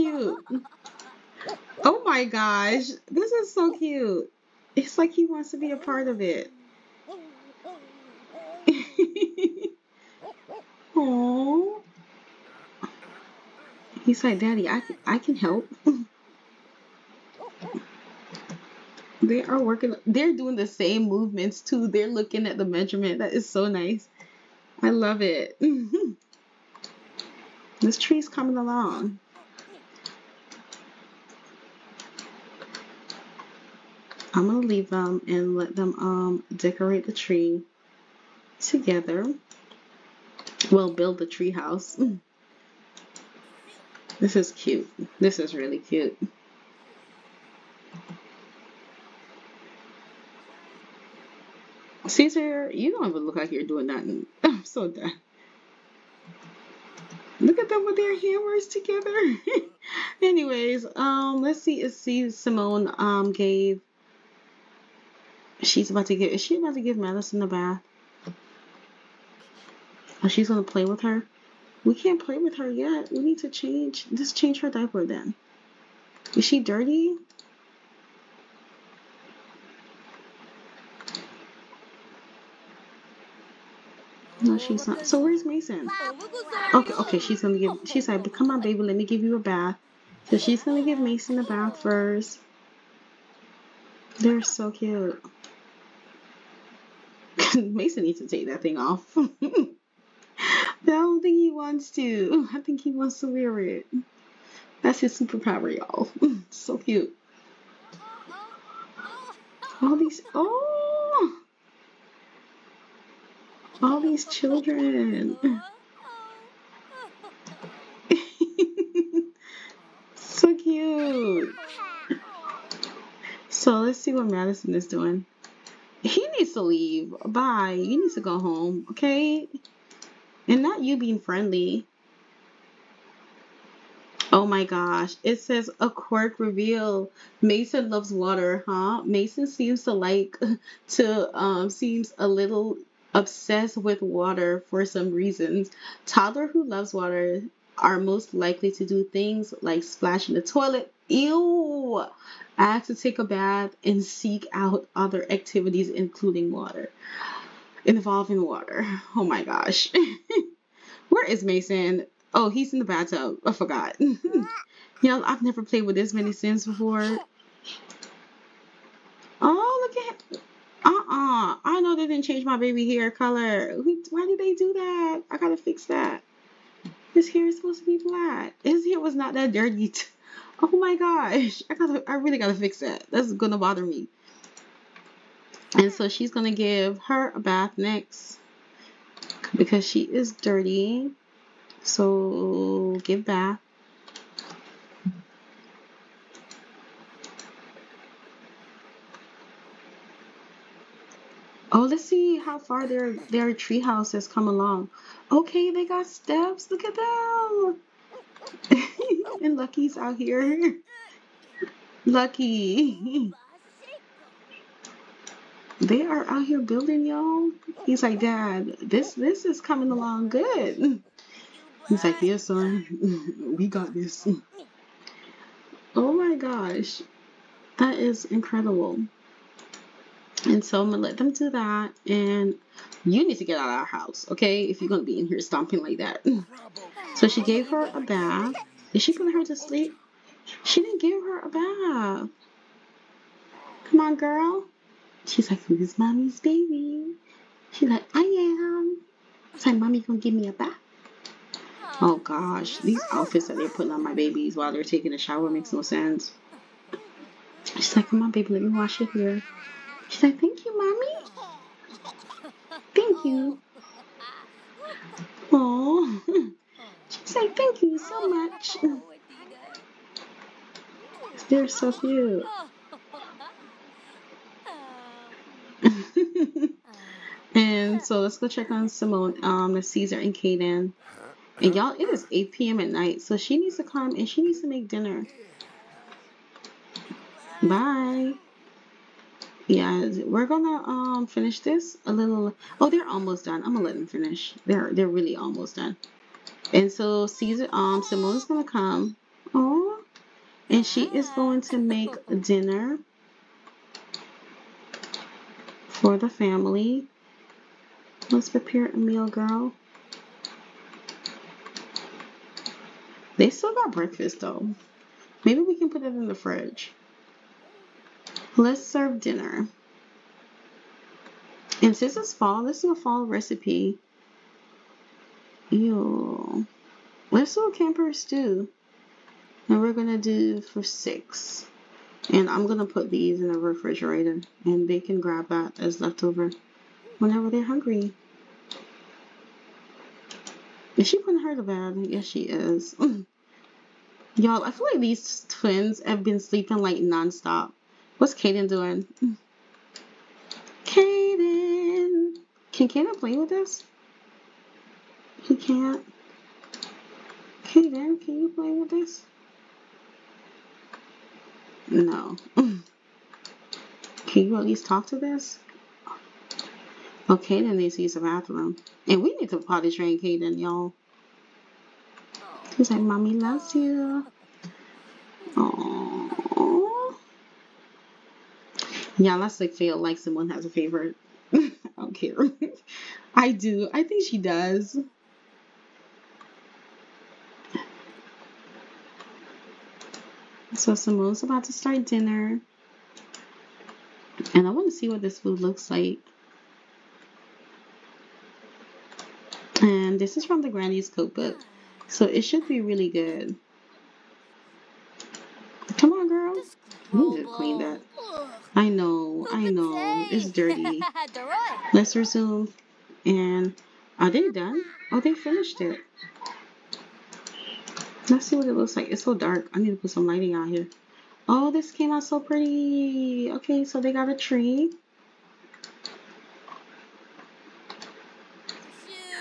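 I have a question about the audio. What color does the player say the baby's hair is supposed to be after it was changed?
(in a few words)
Black.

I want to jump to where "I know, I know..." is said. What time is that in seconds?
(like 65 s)
408 s.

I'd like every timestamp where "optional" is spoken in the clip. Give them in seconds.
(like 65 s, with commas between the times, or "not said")
not said.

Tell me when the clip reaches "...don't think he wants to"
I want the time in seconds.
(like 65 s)
100 s.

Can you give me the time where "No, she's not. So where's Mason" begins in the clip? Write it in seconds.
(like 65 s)
84 s.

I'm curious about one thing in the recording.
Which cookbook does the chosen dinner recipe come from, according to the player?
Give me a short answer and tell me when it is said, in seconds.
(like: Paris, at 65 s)
Granny's cookbook, at 400 s.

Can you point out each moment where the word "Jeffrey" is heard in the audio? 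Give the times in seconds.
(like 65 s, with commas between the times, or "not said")
not said.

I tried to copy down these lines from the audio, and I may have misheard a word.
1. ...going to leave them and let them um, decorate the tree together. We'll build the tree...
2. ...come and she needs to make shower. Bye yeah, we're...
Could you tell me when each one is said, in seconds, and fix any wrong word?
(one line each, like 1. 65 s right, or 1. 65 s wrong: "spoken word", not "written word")
1. 34 s right
2. 283 s wrong: "dinner", not "shower".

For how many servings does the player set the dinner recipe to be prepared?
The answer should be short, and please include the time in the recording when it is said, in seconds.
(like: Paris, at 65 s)
6, at 330 s.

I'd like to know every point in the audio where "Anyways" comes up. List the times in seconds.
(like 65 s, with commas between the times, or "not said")
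60 s.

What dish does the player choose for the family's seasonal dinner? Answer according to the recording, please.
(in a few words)
Camper stew.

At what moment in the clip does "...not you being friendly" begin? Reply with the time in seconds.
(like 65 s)
130 s.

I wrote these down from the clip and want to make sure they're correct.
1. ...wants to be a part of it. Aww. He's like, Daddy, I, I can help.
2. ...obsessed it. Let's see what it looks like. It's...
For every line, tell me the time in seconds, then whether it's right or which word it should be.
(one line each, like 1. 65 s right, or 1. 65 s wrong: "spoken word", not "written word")
1. 5 s right
2. 415 s wrong: "finished", not "obsessed".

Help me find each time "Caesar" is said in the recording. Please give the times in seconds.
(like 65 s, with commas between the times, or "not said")
52 s, 279 s, 297 s.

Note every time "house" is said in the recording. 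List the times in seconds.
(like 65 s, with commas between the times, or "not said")
41 s, 203 s, 233 s.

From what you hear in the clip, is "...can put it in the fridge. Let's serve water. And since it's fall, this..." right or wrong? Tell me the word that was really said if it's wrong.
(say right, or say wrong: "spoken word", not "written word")
wrong: "dinner", not "water".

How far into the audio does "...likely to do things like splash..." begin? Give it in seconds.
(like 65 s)
148 s.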